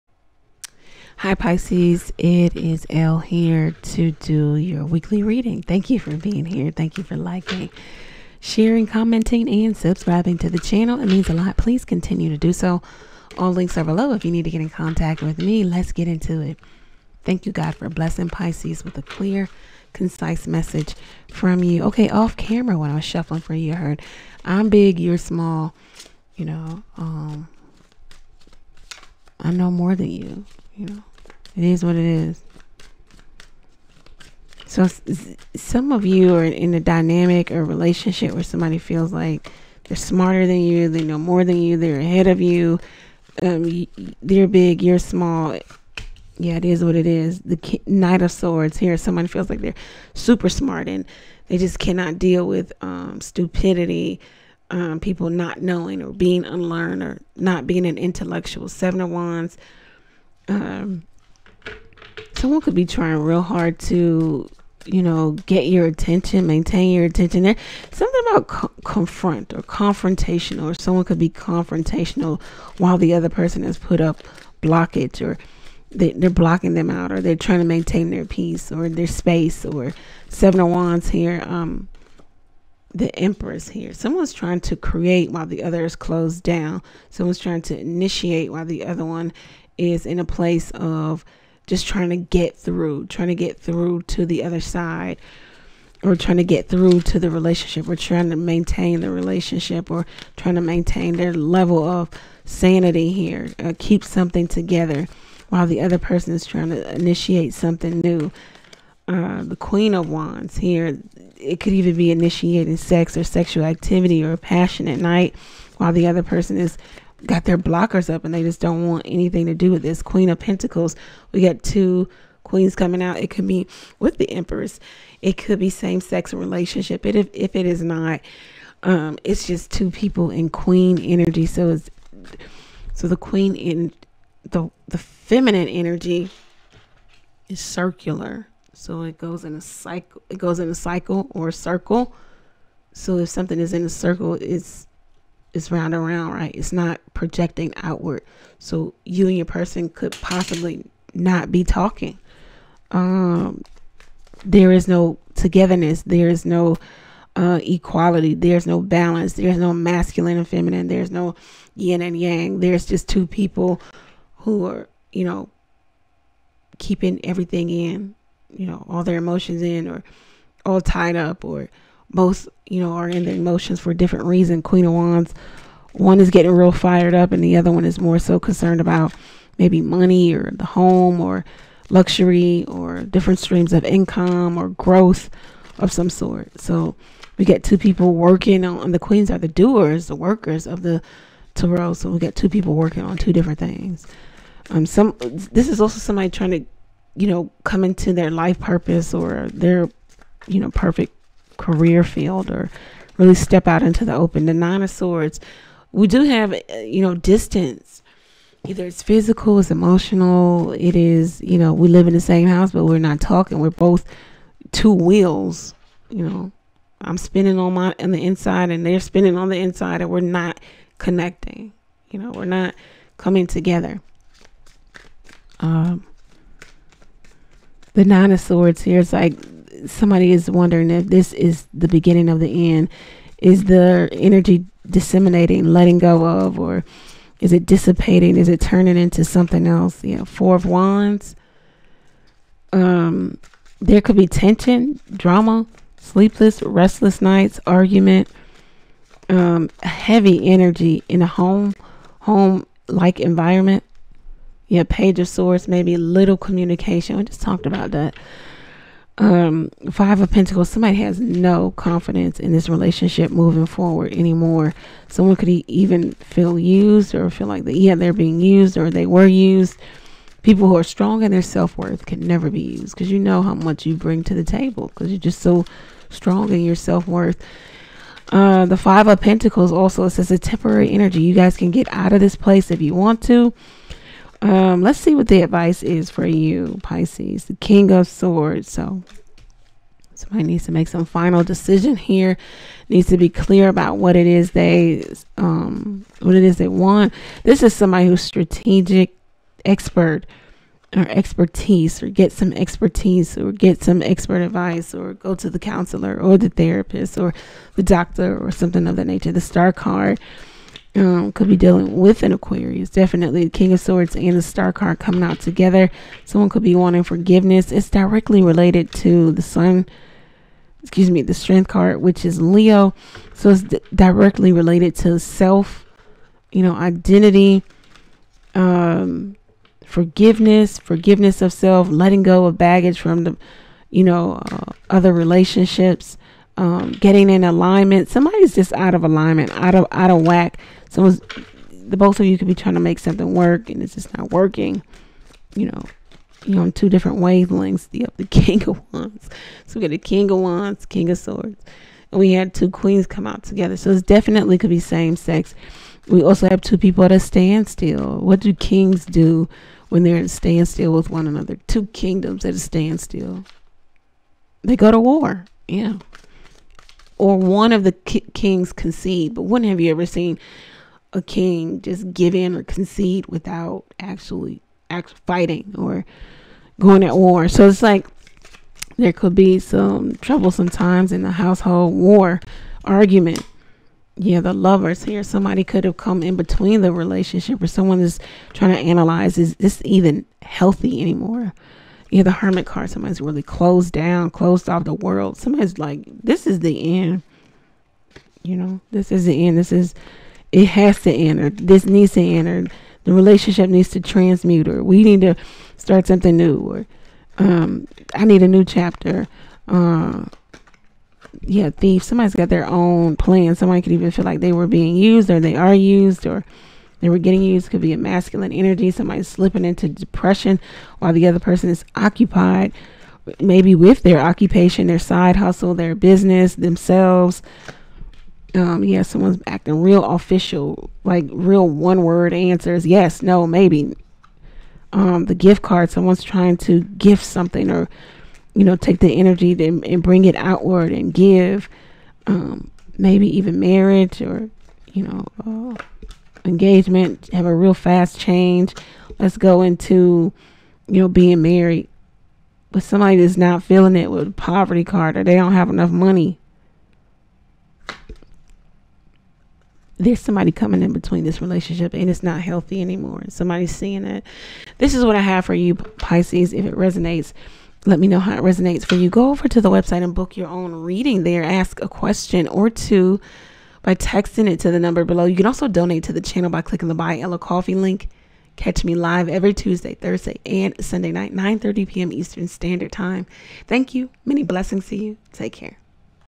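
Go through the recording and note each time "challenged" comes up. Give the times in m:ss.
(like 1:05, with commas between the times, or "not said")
not said.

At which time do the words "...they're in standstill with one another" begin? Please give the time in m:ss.
6:00.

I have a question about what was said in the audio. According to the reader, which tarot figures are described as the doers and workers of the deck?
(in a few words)
The queens.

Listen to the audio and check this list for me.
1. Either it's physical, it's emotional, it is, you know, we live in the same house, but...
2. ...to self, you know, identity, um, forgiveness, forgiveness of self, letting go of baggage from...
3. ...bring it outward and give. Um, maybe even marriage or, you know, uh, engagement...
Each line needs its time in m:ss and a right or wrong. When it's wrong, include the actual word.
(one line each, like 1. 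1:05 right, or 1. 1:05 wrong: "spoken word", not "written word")
1. 3:28 right
2. 5:24 right
3. 7:20 right.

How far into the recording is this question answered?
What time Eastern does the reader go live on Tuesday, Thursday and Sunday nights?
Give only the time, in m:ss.
8:01.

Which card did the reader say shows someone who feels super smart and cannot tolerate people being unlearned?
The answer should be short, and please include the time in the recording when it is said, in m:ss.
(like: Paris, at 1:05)
Knight of Swords, at 0:47.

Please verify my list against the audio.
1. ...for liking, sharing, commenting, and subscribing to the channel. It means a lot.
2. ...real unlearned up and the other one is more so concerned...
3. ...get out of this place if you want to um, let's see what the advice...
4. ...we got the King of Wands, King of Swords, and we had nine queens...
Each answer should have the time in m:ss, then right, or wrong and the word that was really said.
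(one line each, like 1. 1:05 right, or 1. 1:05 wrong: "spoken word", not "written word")
1. 0:07 right
2. 2:56 wrong: "fired", not "unlearned"
3. 4:41 right
4. 5:49 wrong: "two", not "nine".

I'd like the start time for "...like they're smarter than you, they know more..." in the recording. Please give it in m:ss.
0:39.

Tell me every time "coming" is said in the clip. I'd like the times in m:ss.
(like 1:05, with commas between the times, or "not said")
2:02, 3:43, 5:14, 7:40.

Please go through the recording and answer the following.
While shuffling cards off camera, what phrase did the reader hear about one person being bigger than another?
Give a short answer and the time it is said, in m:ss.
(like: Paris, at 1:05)
I'm big, you're small, at 0:24.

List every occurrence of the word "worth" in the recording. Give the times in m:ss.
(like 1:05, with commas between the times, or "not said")
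4:31, 4:36.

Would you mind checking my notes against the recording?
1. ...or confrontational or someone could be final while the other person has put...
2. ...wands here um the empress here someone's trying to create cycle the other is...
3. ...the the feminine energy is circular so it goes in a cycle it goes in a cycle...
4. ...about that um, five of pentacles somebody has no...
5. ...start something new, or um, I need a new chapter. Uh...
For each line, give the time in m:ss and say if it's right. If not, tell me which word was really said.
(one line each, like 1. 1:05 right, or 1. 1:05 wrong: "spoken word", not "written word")
1. 1:09 wrong: "confrontational", not "final"
2. 1:20 wrong: "while", not "cycle"
3. 2:14 right
4. 4:17 right
5. 6:45 right.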